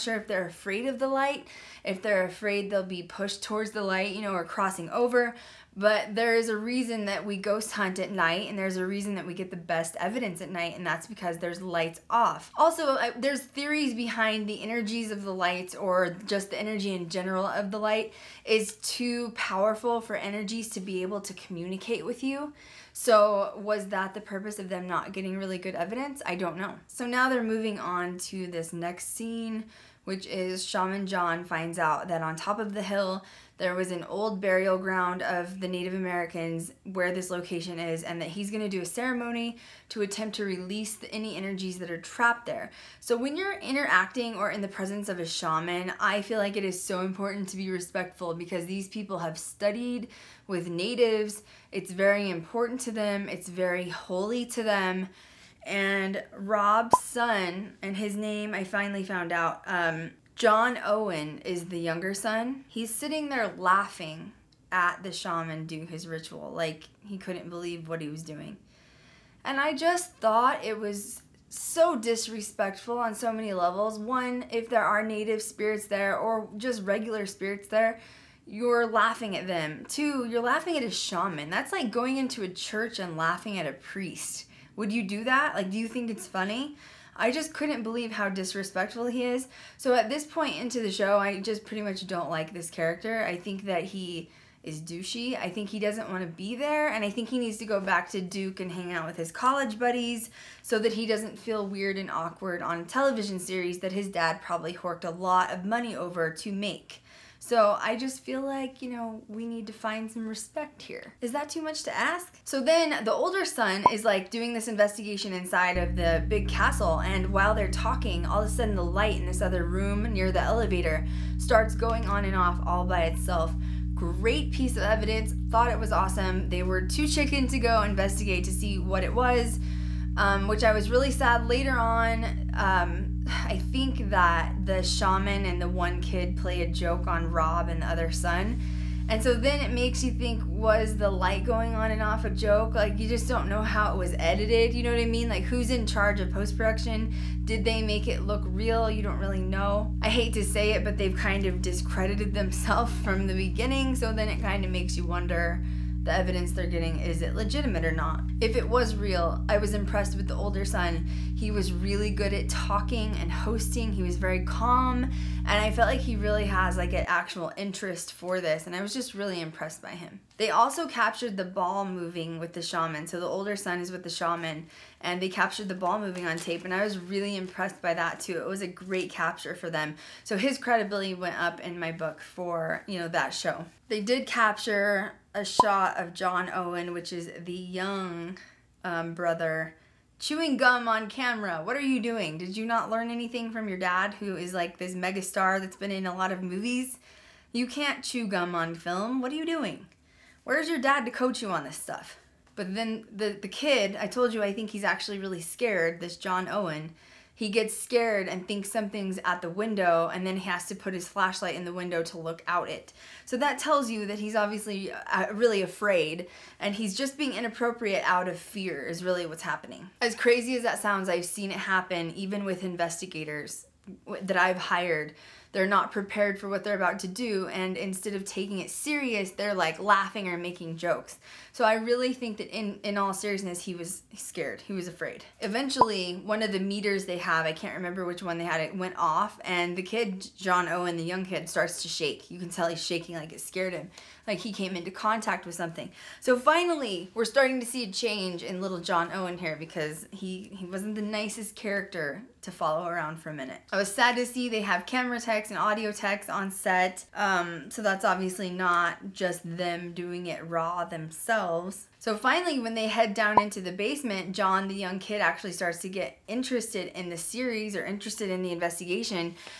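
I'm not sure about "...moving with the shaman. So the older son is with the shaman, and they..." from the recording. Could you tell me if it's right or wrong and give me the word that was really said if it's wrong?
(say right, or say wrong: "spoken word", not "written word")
right.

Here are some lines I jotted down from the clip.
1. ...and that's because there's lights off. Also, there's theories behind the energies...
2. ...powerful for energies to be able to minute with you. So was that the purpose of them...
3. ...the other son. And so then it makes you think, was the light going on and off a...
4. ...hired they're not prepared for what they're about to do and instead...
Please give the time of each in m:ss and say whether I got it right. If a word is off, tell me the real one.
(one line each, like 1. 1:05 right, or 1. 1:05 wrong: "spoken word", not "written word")
1. 0:10 right
2. 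0:19 wrong: "communicate", not "minute"
3. 2:17 right
4. 3:44 right.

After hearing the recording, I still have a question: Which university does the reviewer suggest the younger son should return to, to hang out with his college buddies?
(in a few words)
Duke.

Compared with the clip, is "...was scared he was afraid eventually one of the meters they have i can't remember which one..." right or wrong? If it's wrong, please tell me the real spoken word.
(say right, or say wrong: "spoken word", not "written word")
right.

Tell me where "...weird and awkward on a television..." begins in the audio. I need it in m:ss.
1:41.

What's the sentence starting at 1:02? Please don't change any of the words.
He's sitting there laughing at the shaman do his ritual, like he couldn't believe what he was doing.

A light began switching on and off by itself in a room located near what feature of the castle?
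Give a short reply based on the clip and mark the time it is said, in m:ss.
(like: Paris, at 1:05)
the elevator, at 2:00.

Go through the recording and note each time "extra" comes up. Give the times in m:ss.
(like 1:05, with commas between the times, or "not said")
not said.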